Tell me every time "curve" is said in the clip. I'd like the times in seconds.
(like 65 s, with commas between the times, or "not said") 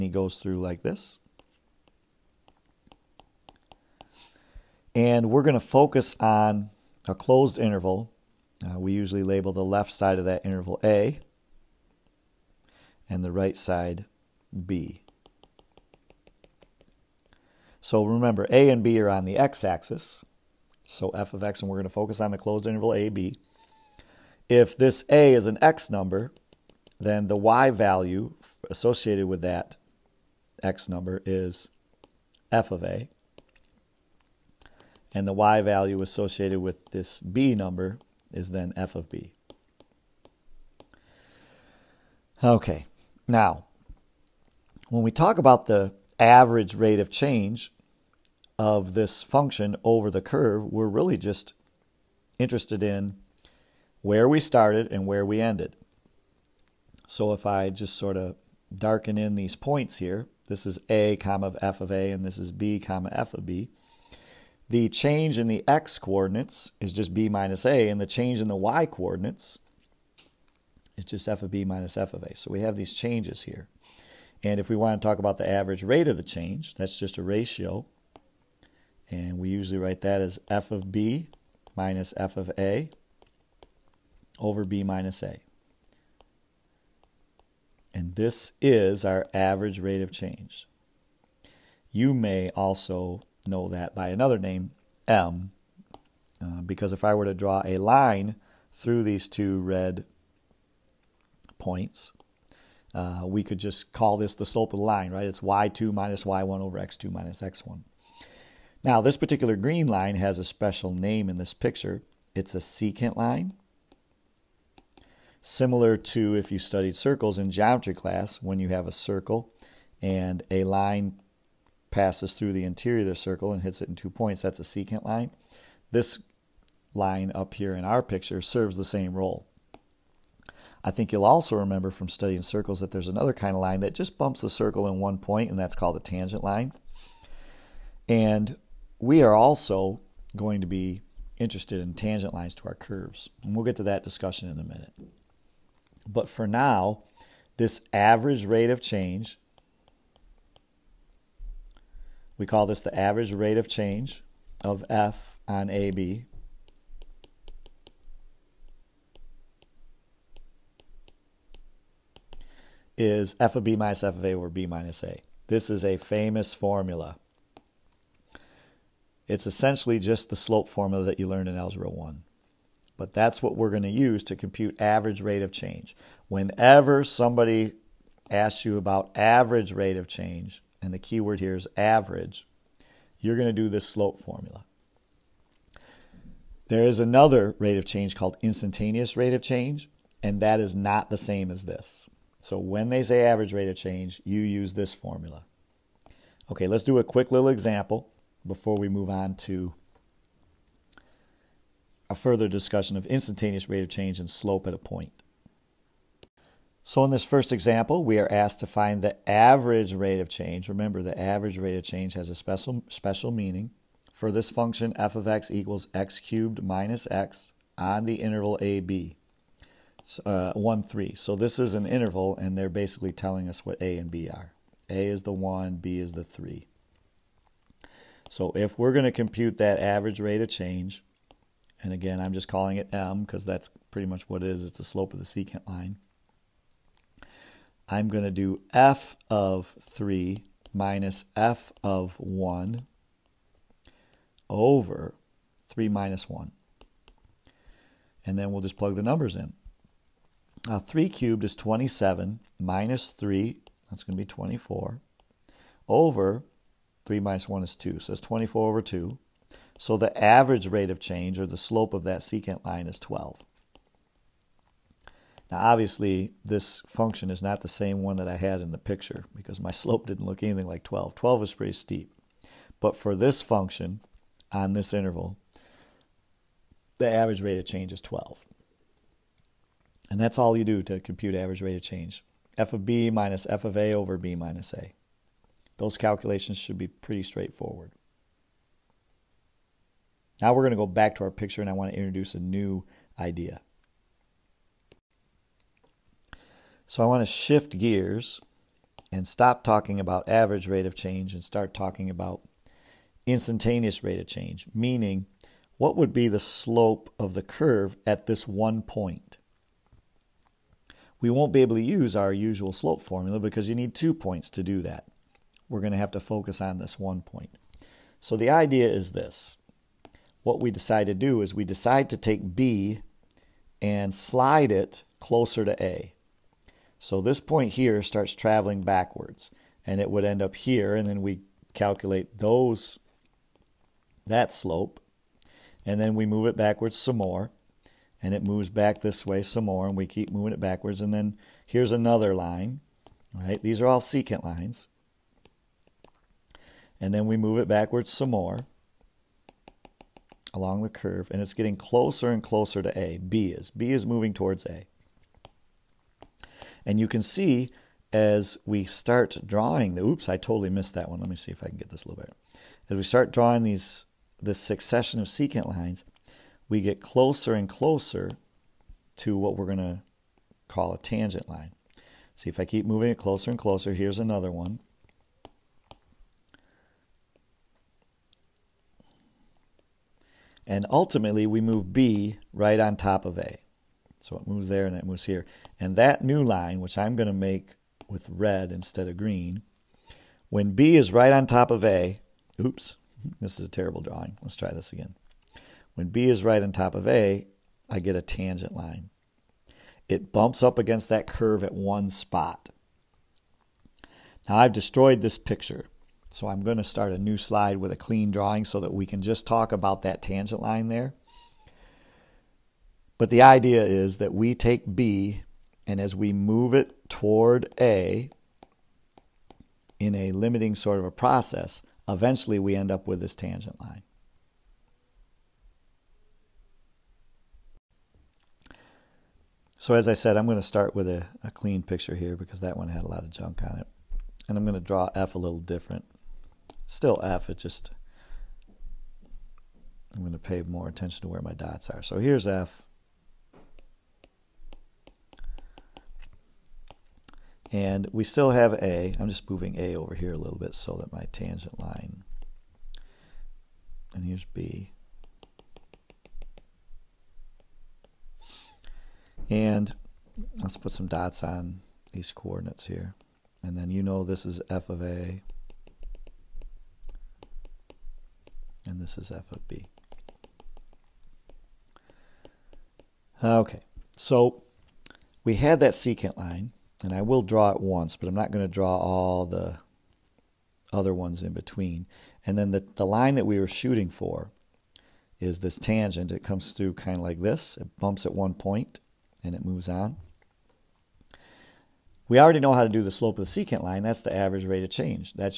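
50 s, 142 s, 307 s, 350 s, 401 s.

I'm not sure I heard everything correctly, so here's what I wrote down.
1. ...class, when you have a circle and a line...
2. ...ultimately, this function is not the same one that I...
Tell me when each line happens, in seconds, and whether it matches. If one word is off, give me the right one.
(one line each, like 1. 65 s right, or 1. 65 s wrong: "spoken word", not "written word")
1. 117 s right
2. 265 s wrong: "obviously", not "ultimately".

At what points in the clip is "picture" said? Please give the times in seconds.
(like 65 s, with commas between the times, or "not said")
111 s, 128 s, 268 s, 291 s, 405 s, 431 s.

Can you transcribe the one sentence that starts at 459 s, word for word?
And let's put some dots on these coordinates here.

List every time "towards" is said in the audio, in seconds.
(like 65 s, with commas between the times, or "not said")
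354 s, 417 s.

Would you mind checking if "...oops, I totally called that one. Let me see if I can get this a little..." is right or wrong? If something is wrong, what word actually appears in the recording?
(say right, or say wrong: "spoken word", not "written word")
wrong: "missed", not "called".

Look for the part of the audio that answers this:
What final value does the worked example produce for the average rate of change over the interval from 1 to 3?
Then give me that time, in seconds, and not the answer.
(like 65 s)
261 s.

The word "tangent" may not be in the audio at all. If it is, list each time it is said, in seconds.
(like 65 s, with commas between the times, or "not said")
136 s, 141 s, 370 s, 398 s, 410 s, 423 s, 451 s, 485 s.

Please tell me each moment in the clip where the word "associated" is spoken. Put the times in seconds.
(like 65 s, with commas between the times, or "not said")
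28 s, 36 s.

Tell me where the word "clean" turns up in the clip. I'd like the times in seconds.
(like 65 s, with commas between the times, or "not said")
407 s, 431 s.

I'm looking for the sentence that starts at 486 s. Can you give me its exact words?
It comes through kind of like this.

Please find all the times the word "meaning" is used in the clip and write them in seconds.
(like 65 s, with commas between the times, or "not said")
213 s, 304 s.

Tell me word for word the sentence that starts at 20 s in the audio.
So f of x, and we're going to focus on the closed interval a, b.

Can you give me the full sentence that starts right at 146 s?
But for now, this average rate of change, we call this the average rate of change of F on AB.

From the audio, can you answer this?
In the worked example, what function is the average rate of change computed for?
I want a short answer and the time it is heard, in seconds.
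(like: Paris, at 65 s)
x cubed minus x, at 214 s.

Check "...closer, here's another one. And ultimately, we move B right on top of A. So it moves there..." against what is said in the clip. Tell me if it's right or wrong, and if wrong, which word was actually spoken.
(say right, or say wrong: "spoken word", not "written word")
right.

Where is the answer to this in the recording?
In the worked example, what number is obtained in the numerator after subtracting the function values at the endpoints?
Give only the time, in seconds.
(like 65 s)
253 s.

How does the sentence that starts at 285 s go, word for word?
Those calculations should be pretty straightforward.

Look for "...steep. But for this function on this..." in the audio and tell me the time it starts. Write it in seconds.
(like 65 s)
271 s.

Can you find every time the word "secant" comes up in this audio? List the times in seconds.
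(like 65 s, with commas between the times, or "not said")
112 s, 124 s, 235 s, 262 s, 344 s, 365 s, 475 s, 493 s.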